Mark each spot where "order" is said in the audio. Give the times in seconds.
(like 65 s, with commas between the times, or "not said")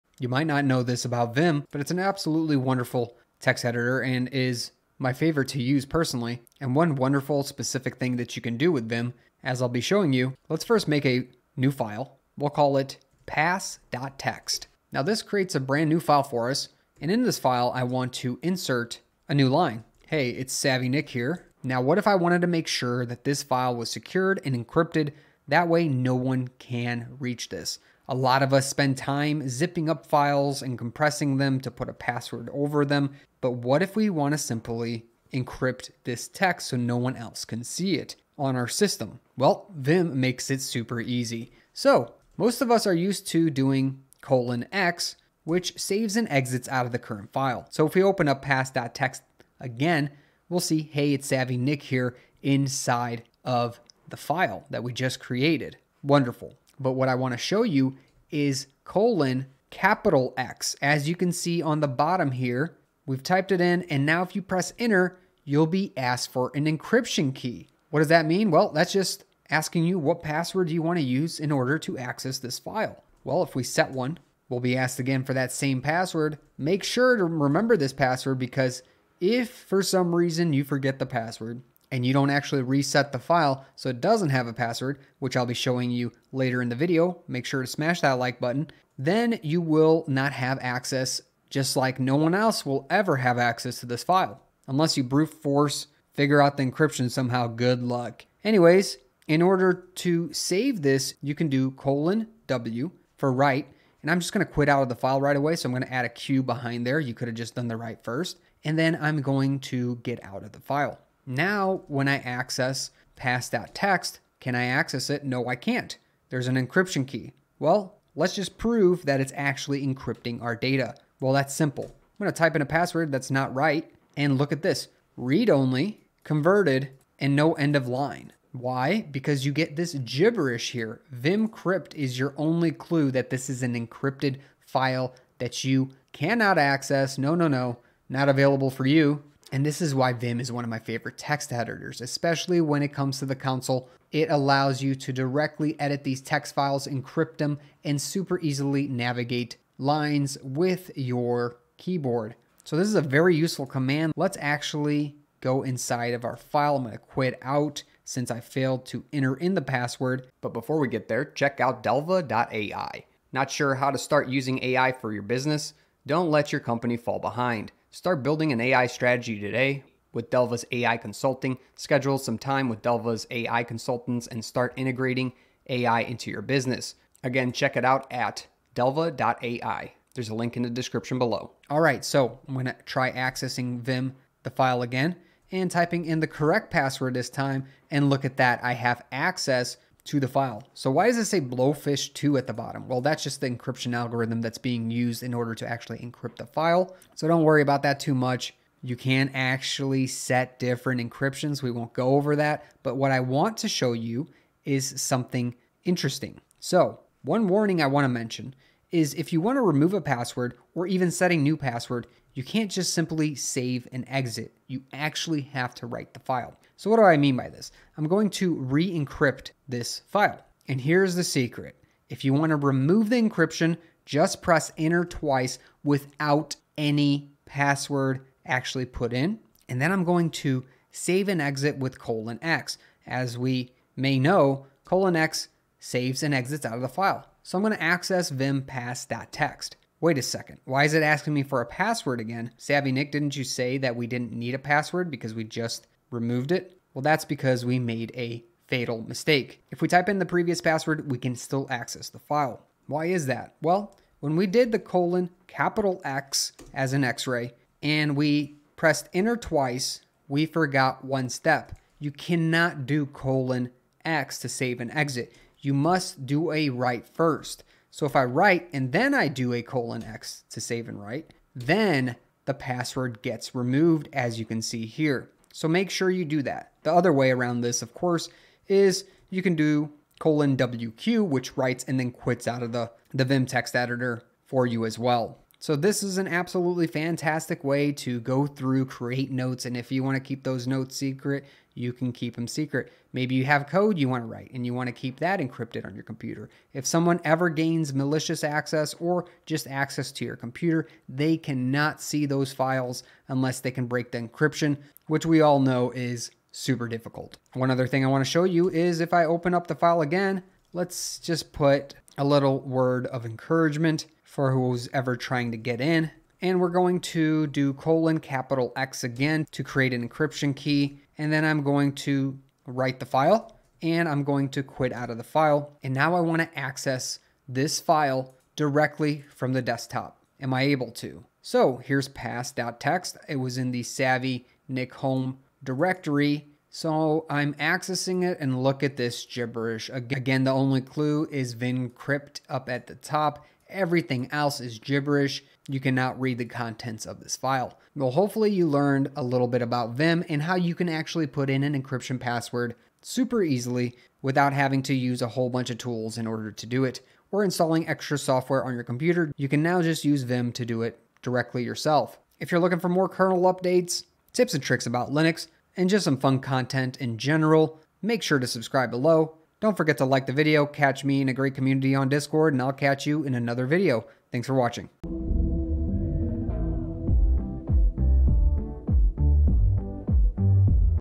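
71 s, 99 s, 195 s, 356 s.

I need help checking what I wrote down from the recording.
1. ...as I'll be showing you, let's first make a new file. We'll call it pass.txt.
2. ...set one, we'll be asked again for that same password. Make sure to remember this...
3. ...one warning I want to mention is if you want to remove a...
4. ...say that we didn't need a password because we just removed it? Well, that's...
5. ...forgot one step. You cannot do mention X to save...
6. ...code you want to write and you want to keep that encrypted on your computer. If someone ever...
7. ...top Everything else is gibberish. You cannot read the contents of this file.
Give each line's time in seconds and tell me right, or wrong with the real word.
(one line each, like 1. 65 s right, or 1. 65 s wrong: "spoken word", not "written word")
1. 9 s right
2. 73 s right
3. 207 s right
4. 243 s right
5. 260 s wrong: "colon", not "mention"
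6. 293 s right
7. 342 s right.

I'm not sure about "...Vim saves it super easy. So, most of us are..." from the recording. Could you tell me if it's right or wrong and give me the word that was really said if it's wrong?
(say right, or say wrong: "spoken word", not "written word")
wrong: "makes", not "saves".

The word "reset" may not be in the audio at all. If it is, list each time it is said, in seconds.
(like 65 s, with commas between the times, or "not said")
82 s.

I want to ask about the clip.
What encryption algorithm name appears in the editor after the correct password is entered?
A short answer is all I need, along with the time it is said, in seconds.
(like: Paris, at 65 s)
Blowfish 2, at 191 s.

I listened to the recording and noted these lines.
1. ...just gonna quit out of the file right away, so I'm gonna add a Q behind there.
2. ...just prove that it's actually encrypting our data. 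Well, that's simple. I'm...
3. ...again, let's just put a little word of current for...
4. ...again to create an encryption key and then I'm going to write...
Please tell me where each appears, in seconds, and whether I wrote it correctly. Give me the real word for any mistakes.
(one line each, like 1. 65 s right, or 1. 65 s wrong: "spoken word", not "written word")
1. 104 s right
2. 118 s right
3. 310 s wrong: "encouragement", not "current"
4. 319 s right.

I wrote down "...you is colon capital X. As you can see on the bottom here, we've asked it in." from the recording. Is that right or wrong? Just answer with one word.
wrong.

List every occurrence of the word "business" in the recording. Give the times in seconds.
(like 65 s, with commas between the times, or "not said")
165 s, 176 s.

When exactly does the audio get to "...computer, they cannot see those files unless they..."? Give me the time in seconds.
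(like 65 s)
300 s.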